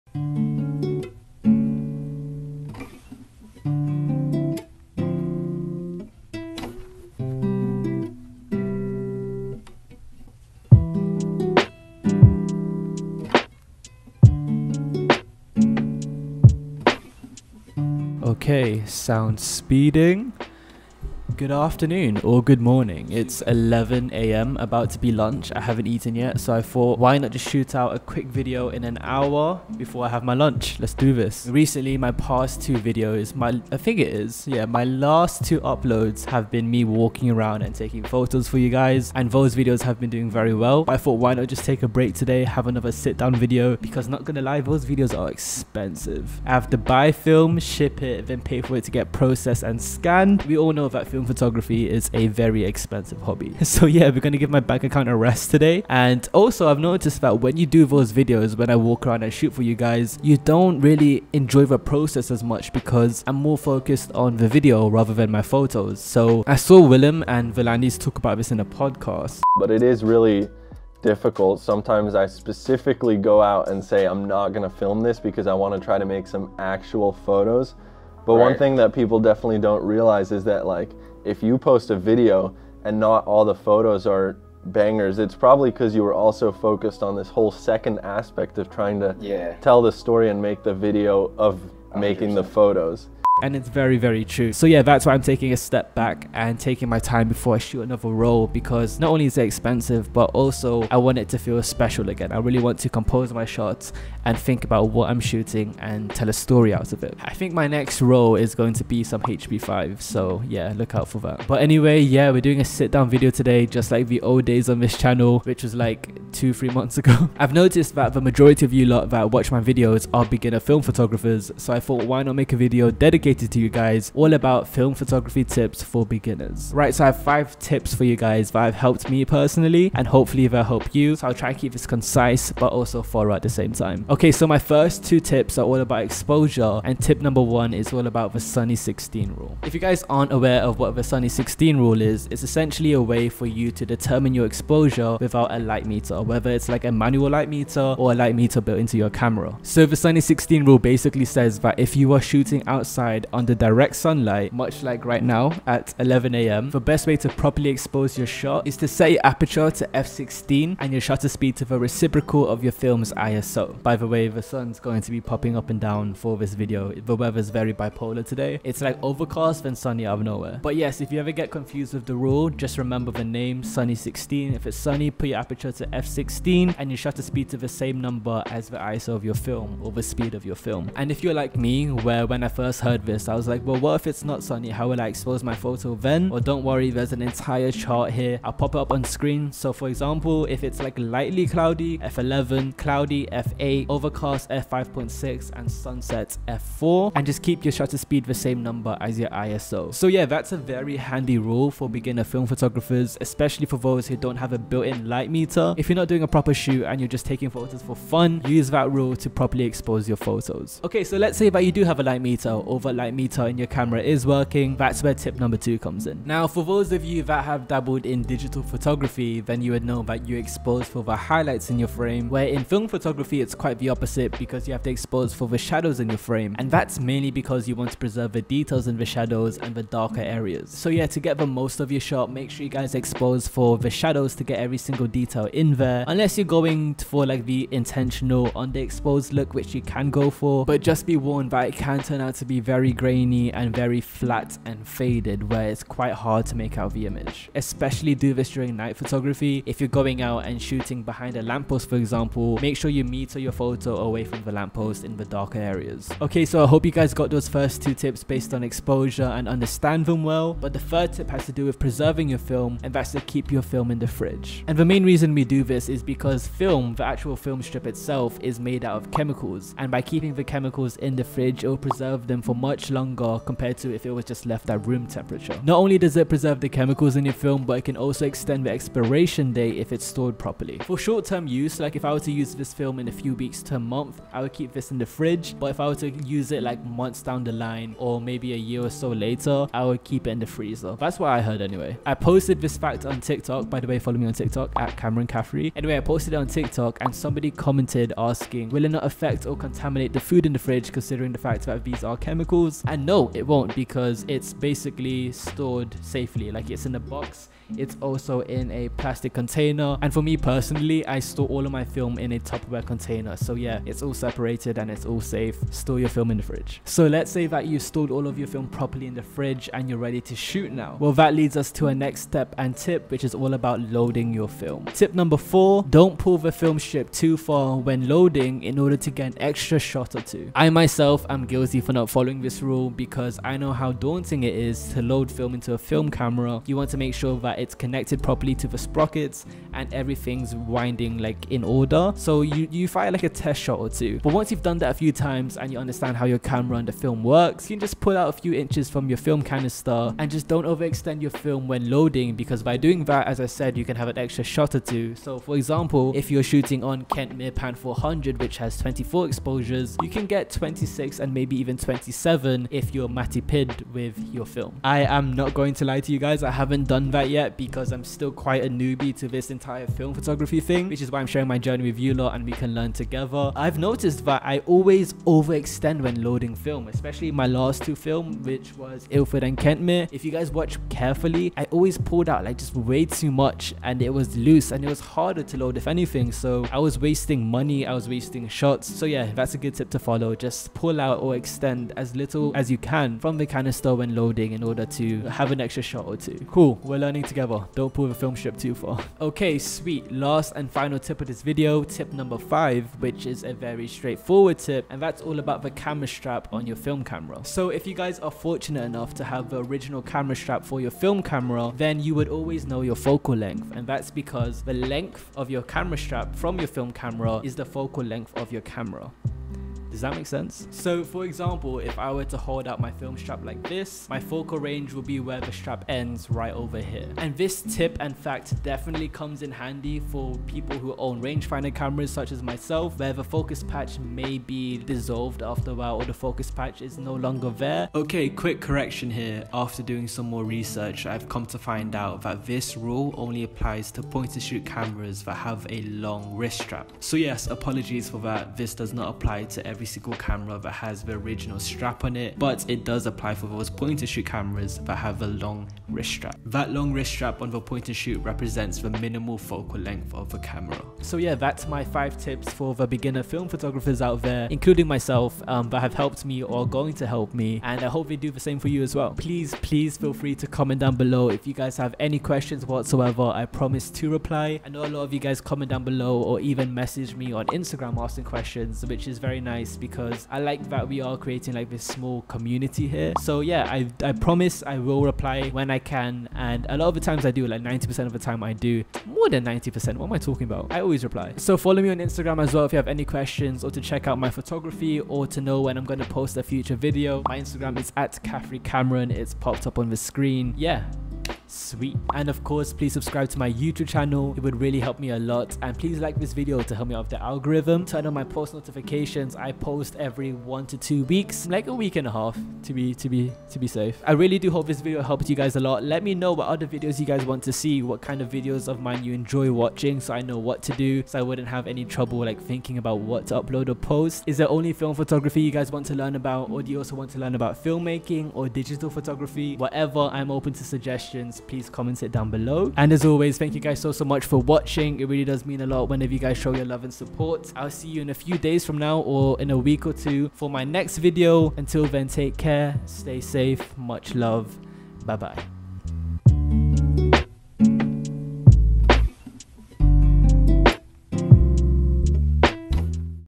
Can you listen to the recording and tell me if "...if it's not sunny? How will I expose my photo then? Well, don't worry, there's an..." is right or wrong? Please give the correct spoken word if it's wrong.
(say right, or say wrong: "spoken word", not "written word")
right.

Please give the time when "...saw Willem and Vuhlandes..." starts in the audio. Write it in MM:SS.
01:06.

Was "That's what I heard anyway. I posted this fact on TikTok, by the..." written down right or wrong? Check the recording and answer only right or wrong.
right.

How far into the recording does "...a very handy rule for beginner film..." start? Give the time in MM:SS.
03:20.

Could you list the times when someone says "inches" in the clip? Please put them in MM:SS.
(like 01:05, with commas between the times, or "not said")
05:48.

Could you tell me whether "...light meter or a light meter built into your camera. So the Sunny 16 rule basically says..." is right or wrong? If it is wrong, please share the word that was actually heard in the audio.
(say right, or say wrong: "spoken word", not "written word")
right.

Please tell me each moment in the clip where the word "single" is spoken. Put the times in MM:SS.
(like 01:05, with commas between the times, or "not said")
03:54, 07:29.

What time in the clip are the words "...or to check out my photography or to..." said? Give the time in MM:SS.
08:13.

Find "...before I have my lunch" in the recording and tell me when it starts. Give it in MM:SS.
00:29.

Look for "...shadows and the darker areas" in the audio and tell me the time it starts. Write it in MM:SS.
03:49.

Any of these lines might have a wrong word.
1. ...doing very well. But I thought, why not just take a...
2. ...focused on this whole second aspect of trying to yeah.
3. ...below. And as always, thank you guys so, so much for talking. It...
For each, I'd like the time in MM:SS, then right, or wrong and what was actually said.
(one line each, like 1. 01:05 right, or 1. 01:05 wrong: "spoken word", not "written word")
1. 00:40 right
2. 01:26 right
3. 08:52 wrong: "watching", not "talking".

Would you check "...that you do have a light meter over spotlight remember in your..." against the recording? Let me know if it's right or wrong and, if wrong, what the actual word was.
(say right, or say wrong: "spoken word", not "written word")
wrong: "meter", not "remember".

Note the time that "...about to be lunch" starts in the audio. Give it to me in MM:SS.
00:24.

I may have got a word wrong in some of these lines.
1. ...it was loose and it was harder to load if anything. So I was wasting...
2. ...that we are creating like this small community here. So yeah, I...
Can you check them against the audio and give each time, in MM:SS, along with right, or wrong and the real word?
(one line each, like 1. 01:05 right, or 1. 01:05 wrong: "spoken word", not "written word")
1. 06:24 right
2. 08:00 right.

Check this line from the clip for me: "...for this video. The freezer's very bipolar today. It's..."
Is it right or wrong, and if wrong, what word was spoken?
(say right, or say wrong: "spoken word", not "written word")
wrong: "weather", not "freezer".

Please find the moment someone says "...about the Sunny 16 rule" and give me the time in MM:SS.
02:18.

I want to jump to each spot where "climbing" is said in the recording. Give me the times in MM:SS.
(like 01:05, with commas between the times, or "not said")
not said.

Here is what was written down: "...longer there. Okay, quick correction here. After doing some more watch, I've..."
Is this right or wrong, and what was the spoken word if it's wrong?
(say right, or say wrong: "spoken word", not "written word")
wrong: "research", not "watch".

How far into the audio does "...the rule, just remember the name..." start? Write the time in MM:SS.
02:52.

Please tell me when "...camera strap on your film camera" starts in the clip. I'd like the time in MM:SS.
06:45.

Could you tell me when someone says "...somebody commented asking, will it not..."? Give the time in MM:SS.
04:57.